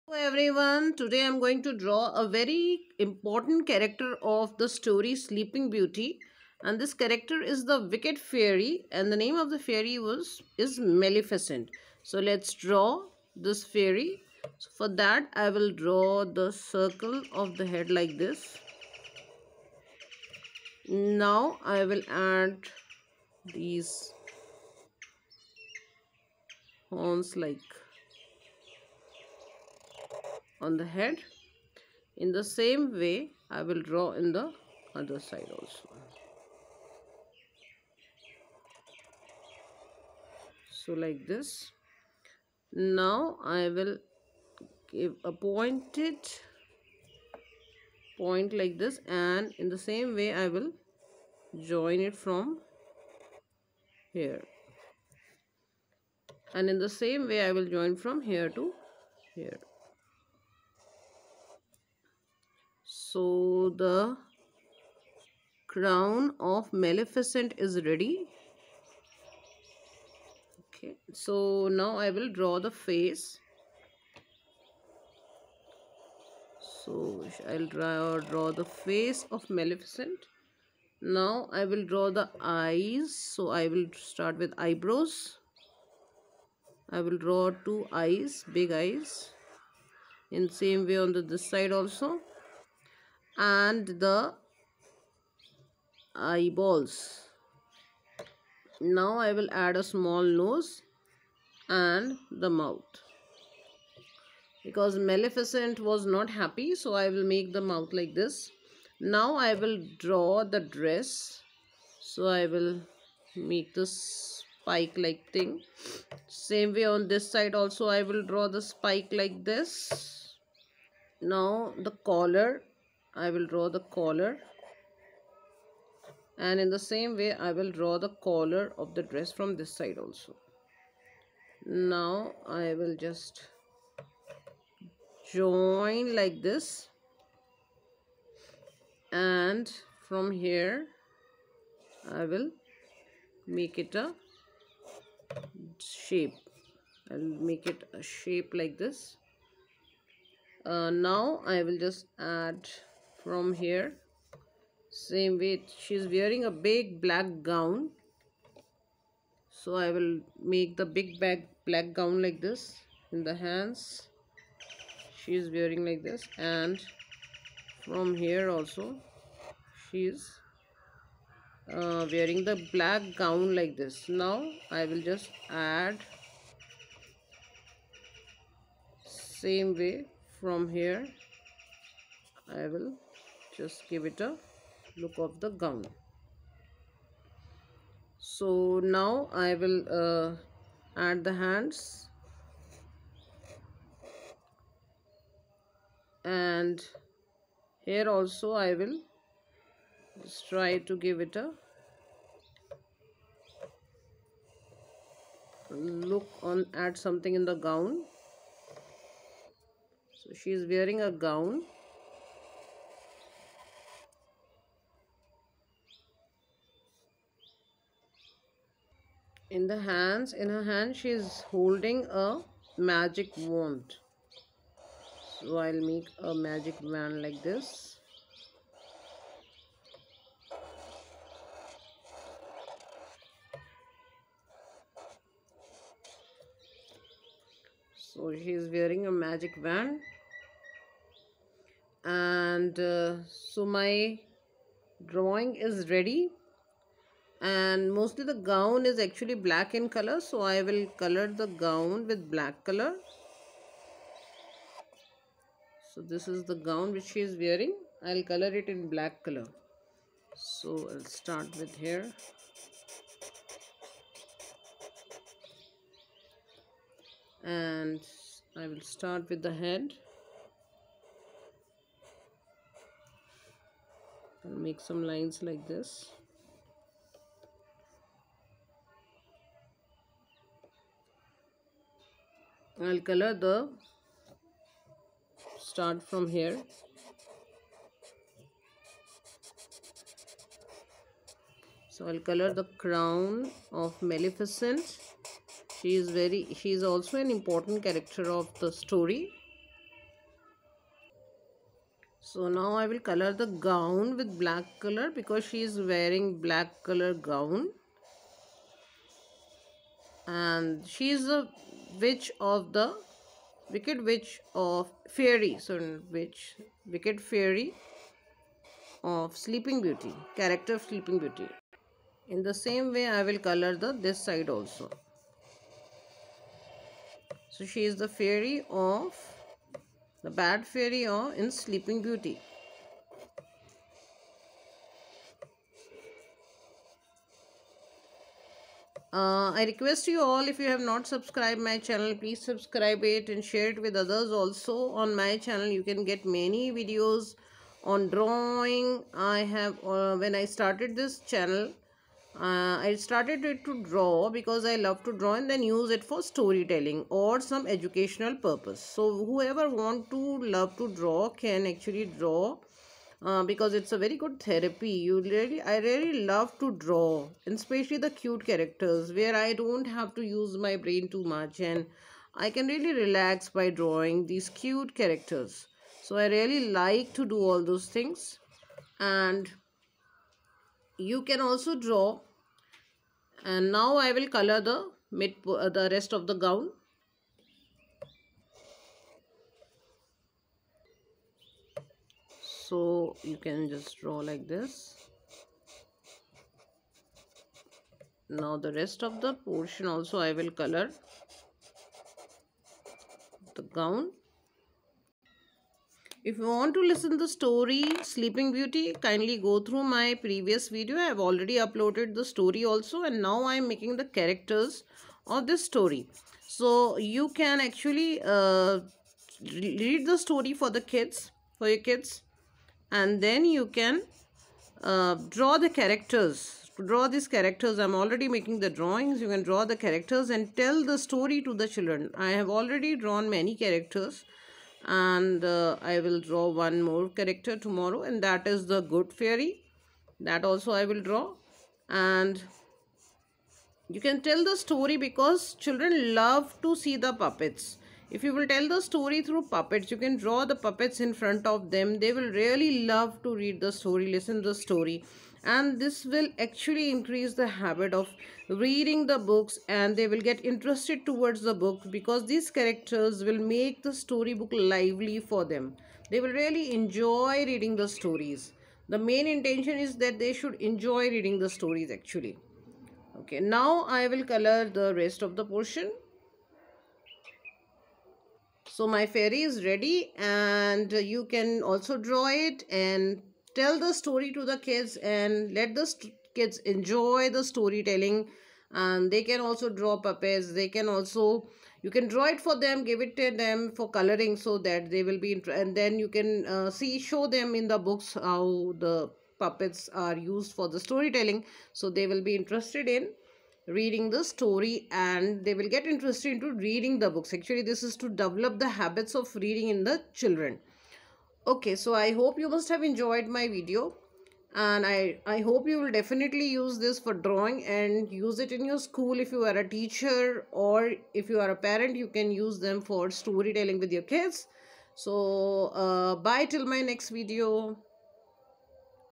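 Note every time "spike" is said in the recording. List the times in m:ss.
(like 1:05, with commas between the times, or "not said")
1:54, 1:58.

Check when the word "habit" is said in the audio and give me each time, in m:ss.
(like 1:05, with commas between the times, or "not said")
7:37, 8:28.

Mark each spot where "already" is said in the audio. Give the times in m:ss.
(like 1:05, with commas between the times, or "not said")
6:51, 7:07, 7:12.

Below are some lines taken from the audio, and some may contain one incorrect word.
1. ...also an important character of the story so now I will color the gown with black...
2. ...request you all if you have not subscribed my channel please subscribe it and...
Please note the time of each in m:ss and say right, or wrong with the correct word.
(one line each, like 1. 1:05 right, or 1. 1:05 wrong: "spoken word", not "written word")
1. 4:56 right
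2. 5:39 right.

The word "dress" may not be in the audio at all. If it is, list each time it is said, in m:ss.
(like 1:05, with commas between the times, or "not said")
1:50, 2:09.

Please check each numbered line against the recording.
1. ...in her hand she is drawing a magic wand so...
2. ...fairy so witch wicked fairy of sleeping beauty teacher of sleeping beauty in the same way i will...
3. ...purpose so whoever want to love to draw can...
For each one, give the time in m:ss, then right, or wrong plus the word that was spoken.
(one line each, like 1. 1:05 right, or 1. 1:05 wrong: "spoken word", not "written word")
1. 3:40 wrong: "holding", not "drawing"
2. 5:15 wrong: "character", not "teacher"
3. 5:58 right.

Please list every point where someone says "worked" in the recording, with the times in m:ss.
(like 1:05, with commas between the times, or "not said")
not said.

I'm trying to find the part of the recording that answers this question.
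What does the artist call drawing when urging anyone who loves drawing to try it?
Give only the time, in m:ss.
6:04.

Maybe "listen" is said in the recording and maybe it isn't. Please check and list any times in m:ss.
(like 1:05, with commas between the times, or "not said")
6:46, 7:34.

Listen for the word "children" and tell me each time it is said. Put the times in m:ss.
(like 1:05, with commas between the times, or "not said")
7:11, 7:25, 8:30.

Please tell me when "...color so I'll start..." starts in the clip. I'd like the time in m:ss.
4:19.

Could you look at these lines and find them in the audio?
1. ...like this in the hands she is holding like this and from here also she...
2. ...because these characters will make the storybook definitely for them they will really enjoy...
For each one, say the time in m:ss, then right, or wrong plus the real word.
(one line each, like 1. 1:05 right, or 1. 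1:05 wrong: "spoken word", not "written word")
1. 2:42 wrong: "wearing", not "holding"
2. 7:41 wrong: "lively", not "definitely".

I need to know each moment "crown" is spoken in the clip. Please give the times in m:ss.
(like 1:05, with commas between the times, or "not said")
1:05, 4:52.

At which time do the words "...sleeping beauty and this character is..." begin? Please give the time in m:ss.
0:05.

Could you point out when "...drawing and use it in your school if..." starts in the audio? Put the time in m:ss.
8:37.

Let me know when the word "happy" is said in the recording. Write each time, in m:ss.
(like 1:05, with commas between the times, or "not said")
1:46.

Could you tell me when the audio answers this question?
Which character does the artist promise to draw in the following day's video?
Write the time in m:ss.
7:18.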